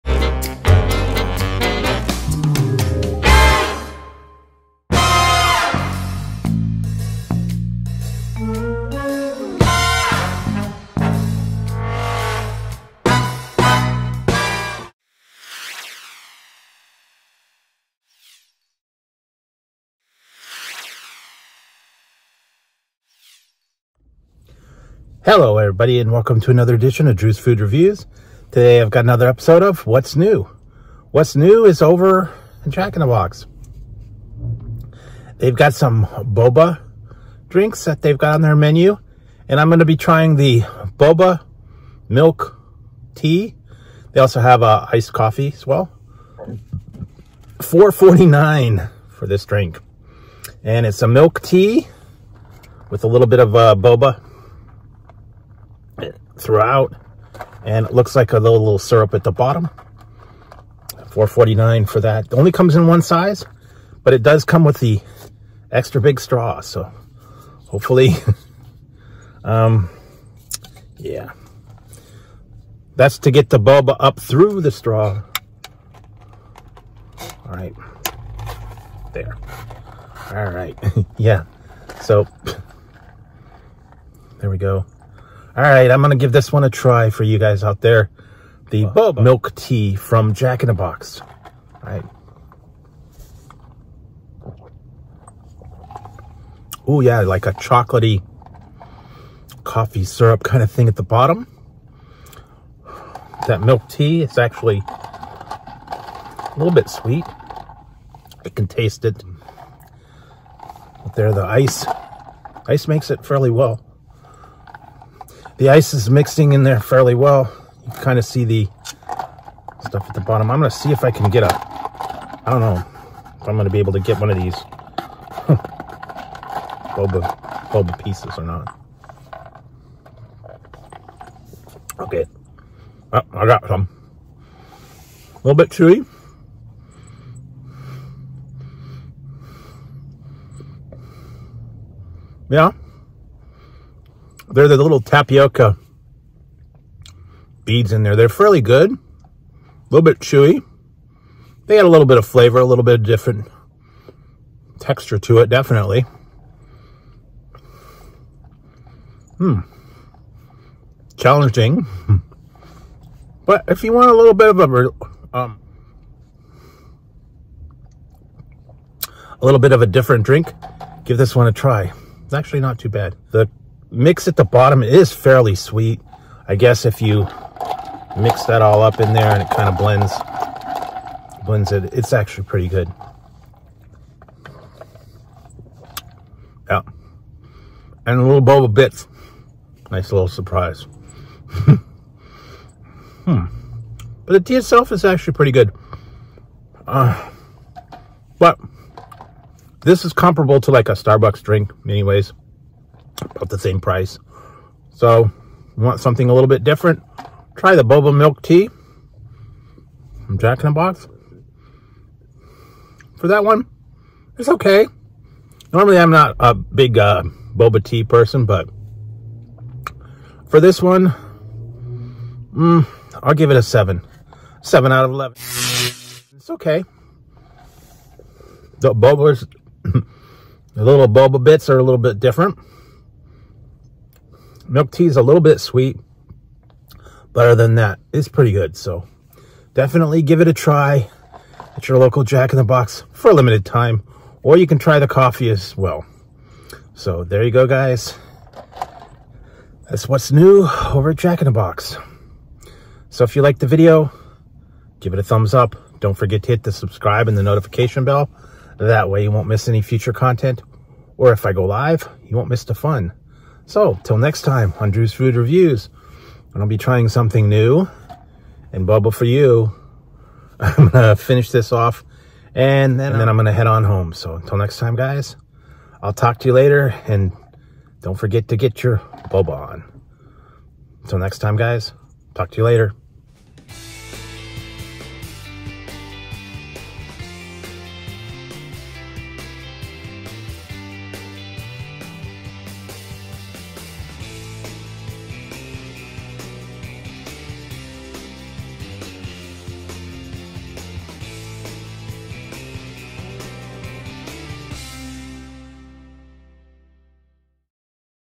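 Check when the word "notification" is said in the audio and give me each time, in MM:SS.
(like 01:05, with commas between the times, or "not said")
04:17.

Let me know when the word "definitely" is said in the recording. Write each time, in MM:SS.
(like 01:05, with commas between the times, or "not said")
02:35, 03:59.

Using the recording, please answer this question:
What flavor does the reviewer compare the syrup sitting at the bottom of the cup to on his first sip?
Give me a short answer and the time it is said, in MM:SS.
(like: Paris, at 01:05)
chocolatey coffee syrup, at 01:37.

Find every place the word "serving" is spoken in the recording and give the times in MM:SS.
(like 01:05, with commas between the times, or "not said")
not said.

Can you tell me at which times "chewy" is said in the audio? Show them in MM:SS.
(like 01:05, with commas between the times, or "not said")
02:15, 02:30.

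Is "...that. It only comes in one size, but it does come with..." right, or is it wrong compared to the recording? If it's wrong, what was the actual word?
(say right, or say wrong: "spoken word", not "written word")
right.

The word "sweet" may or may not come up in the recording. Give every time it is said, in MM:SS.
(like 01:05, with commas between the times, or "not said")
01:46, 02:55, 03:55.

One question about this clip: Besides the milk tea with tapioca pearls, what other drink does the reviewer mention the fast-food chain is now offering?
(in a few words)
iced coffee.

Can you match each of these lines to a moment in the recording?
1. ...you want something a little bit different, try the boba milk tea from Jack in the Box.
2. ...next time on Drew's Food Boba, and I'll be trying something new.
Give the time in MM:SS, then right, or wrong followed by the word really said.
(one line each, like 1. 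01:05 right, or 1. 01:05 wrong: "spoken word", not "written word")
1. 03:25 right
2. 04:24 wrong: "Reviews", not "Boba".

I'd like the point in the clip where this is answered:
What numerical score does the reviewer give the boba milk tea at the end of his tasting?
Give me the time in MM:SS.
03:44.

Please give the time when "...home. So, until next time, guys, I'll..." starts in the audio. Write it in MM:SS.
04:33.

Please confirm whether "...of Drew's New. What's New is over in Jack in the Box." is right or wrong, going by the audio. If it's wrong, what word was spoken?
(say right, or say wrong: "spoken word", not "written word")
wrong: "What", not "Drew".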